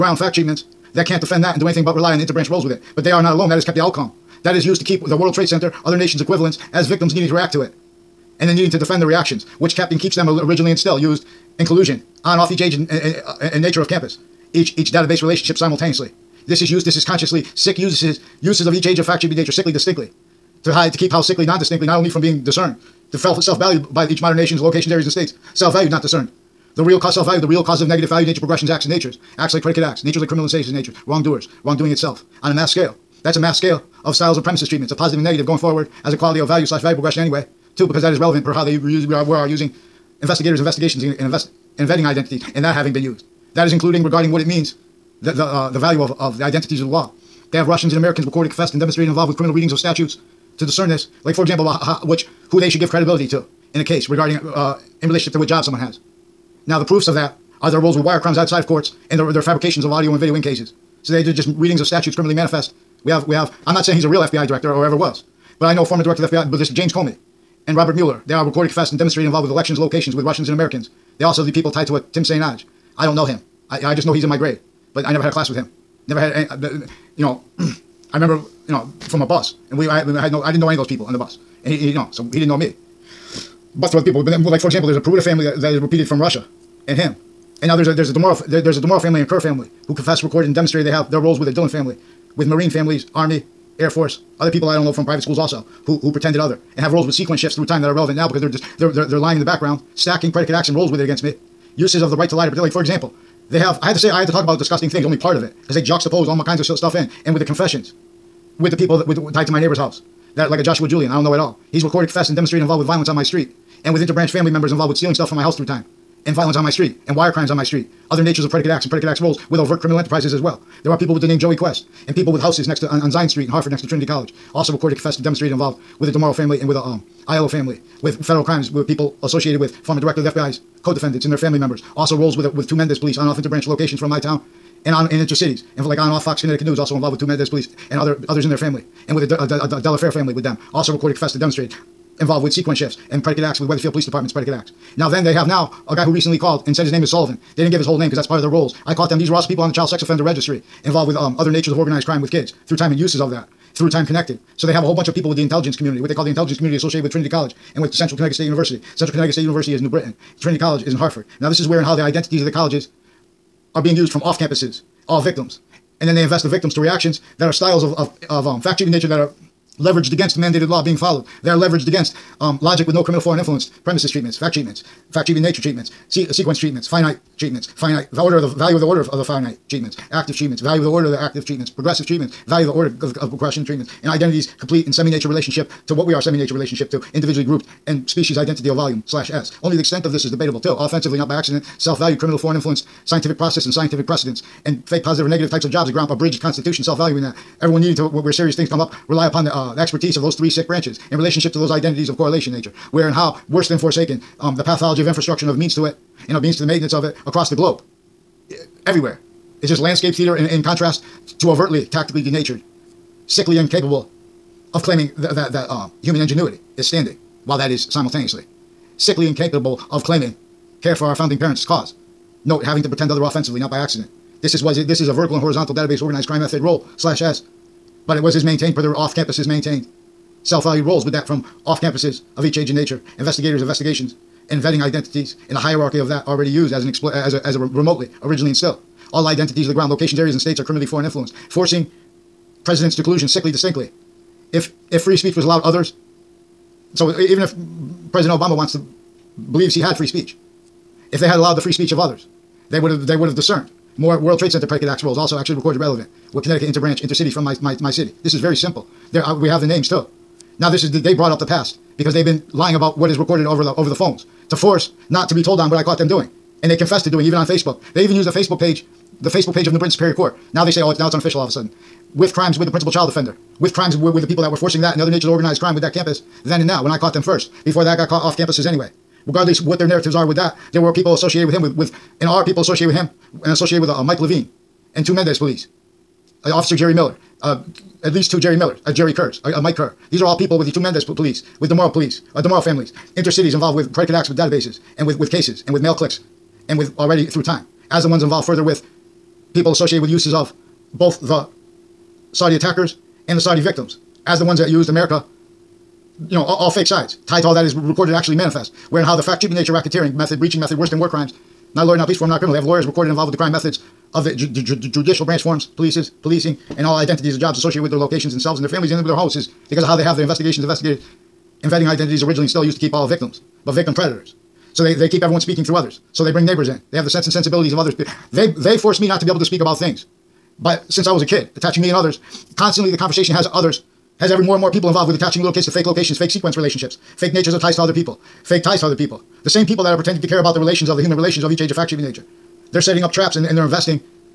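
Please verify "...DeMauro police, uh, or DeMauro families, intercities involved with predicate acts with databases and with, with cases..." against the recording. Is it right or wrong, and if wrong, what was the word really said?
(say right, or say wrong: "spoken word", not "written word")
right.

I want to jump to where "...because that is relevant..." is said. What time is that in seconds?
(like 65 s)
37 s.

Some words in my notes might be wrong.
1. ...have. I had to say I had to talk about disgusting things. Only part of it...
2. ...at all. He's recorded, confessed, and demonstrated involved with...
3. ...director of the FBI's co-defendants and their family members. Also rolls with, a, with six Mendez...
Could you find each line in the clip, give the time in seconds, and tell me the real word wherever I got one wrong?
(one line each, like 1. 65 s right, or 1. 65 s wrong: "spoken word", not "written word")
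1. 103 s right
2. 111 s right
3. 129 s wrong: "two", not "six".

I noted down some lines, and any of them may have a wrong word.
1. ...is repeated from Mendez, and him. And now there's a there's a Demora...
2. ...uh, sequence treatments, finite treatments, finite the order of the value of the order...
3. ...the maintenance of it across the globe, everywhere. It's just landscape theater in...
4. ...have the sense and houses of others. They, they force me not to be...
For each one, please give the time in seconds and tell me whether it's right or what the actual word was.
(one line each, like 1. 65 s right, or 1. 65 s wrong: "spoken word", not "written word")
1. 85 s wrong: "Russia", not "Mendez"
2. 175 s right
3. 206 s right
4. 326 s wrong: "sensibilities", not "houses".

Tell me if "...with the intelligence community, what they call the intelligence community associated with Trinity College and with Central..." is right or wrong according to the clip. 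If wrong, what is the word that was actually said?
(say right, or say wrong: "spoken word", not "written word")
right.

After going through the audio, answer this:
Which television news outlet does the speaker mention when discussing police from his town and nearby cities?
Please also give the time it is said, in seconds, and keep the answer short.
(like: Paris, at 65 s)
Fox Connecticut News, at 136 s.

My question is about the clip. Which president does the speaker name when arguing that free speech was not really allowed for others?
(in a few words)
Obama.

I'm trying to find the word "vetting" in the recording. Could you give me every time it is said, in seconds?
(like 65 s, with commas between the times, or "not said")
234 s, 321 s.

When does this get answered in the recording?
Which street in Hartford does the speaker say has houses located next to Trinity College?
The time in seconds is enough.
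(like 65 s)
123 s.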